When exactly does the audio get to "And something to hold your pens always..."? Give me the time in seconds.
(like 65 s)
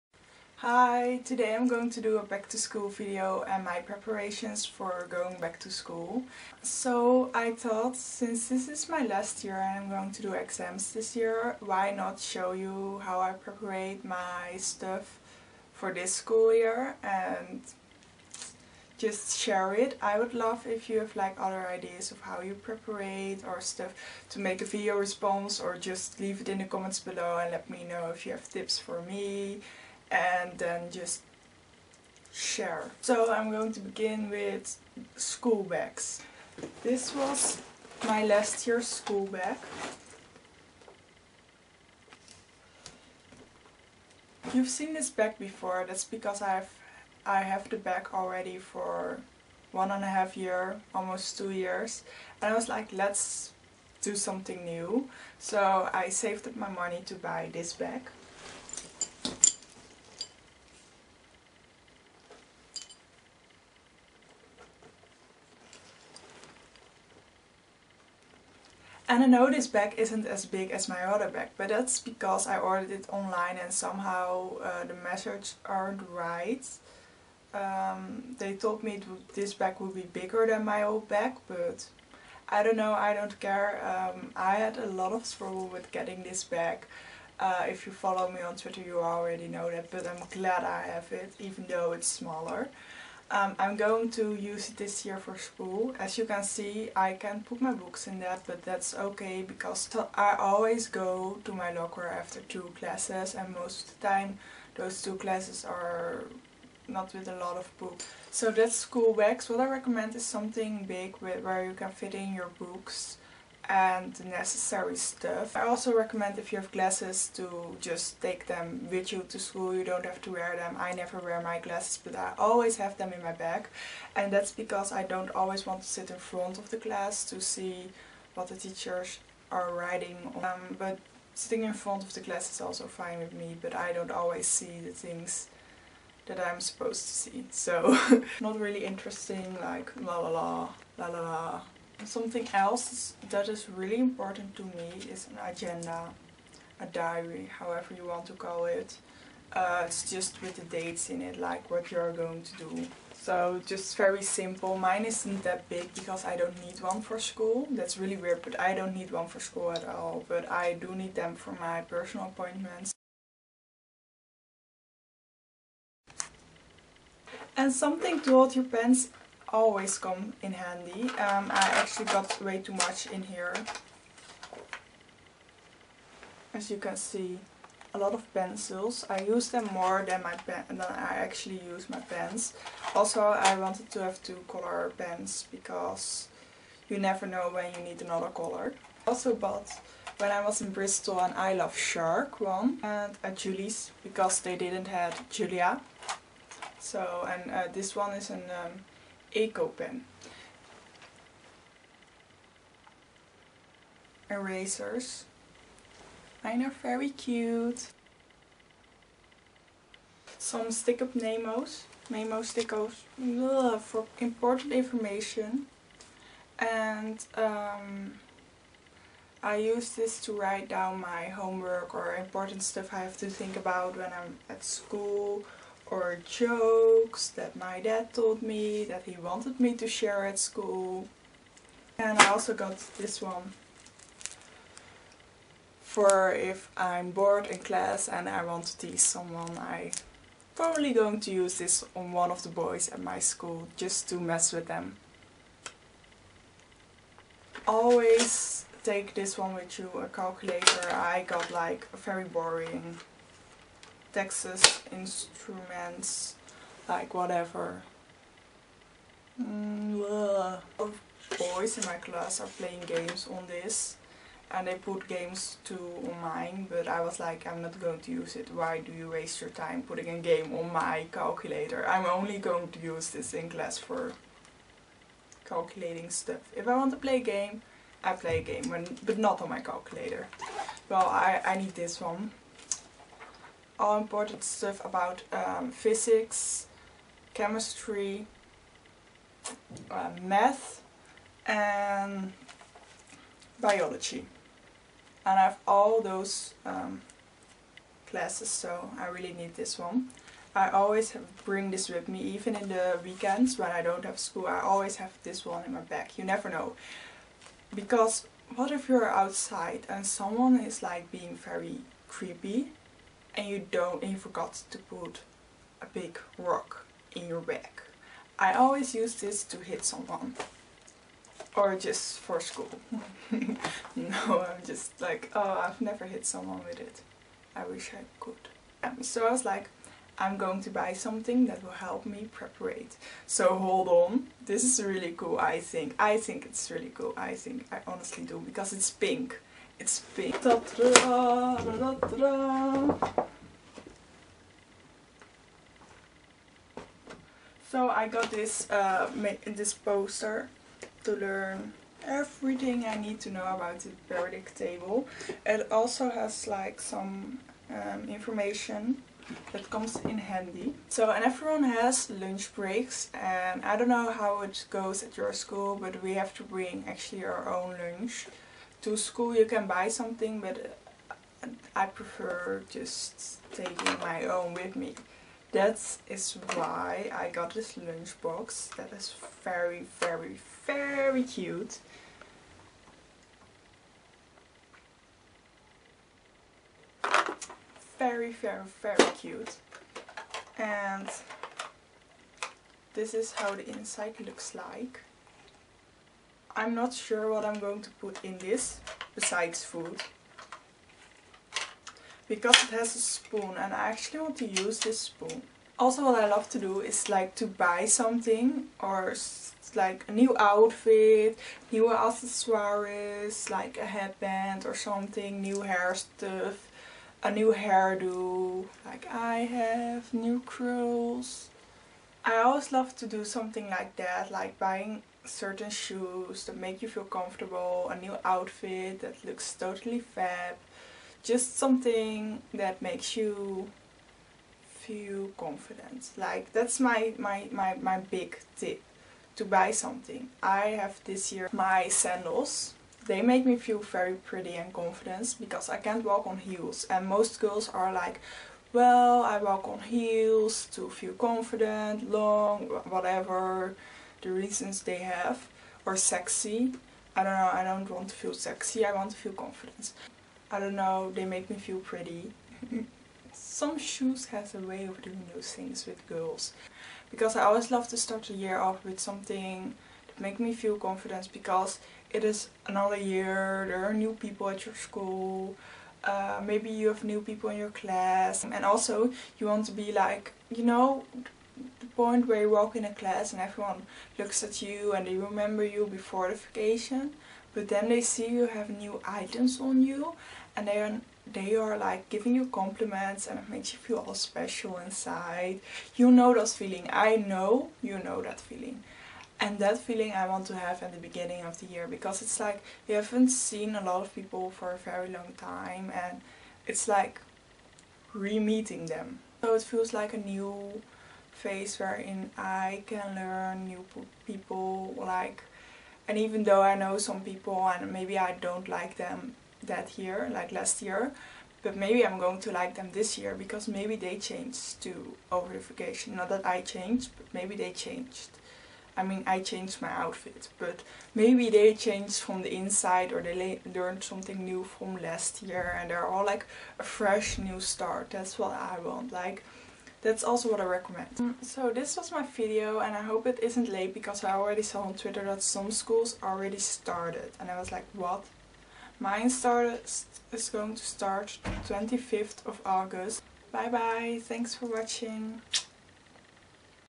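167 s.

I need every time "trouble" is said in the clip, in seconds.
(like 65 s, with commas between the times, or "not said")
85 s.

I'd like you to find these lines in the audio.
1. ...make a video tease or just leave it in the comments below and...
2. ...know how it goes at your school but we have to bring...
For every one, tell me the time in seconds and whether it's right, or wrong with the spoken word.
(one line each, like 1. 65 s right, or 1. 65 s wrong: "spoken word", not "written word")
1. 24 s wrong: "response", not "tease"
2. 363 s right.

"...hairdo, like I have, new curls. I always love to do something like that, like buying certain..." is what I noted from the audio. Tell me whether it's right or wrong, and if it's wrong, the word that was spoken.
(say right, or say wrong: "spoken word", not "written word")
right.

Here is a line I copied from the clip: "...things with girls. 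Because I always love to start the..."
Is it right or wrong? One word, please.
right.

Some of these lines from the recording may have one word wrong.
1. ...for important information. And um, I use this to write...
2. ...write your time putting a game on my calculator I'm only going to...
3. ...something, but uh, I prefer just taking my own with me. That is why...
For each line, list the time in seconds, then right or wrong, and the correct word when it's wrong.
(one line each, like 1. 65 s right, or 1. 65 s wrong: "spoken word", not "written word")
1. 213 s right
2. 269 s wrong: "waste", not "write"
3. 369 s right.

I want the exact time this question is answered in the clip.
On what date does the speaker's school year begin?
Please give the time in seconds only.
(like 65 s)
551 s.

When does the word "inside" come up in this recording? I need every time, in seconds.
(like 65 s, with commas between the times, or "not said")
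393 s, 494 s, 532 s.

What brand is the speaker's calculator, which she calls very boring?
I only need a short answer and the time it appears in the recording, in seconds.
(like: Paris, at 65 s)
Texas Instruments, at 254 s.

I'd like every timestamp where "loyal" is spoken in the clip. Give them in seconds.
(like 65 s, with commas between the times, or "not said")
not said.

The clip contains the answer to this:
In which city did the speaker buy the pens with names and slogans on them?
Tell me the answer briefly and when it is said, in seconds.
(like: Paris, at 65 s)
Bristol, at 190 s.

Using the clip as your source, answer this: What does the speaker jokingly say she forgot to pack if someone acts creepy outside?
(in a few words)
a big rock.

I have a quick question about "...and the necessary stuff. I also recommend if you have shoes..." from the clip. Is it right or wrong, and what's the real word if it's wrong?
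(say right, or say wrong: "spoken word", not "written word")
wrong: "glasses", not "shoes".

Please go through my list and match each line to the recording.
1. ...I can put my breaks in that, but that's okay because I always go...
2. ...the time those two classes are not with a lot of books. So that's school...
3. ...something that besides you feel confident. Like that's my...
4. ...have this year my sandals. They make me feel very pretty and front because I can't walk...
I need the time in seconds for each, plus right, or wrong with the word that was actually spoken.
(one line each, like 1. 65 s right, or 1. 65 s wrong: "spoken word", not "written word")
1. 96 s wrong: "books", not "breaks"
2. 104 s right
3. 431 s wrong: "makes", not "besides"
4. 440 s wrong: "confident", not "front".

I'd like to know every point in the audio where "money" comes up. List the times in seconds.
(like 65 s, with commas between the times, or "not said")
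56 s.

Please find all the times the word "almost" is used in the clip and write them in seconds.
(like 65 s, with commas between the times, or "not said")
50 s.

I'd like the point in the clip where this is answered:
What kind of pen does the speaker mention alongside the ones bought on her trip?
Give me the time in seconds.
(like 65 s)
199 s.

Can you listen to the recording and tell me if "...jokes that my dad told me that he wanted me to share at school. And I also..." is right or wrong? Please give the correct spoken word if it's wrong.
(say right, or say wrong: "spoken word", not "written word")
right.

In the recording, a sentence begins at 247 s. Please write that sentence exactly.
Always take this one with you, a calculator.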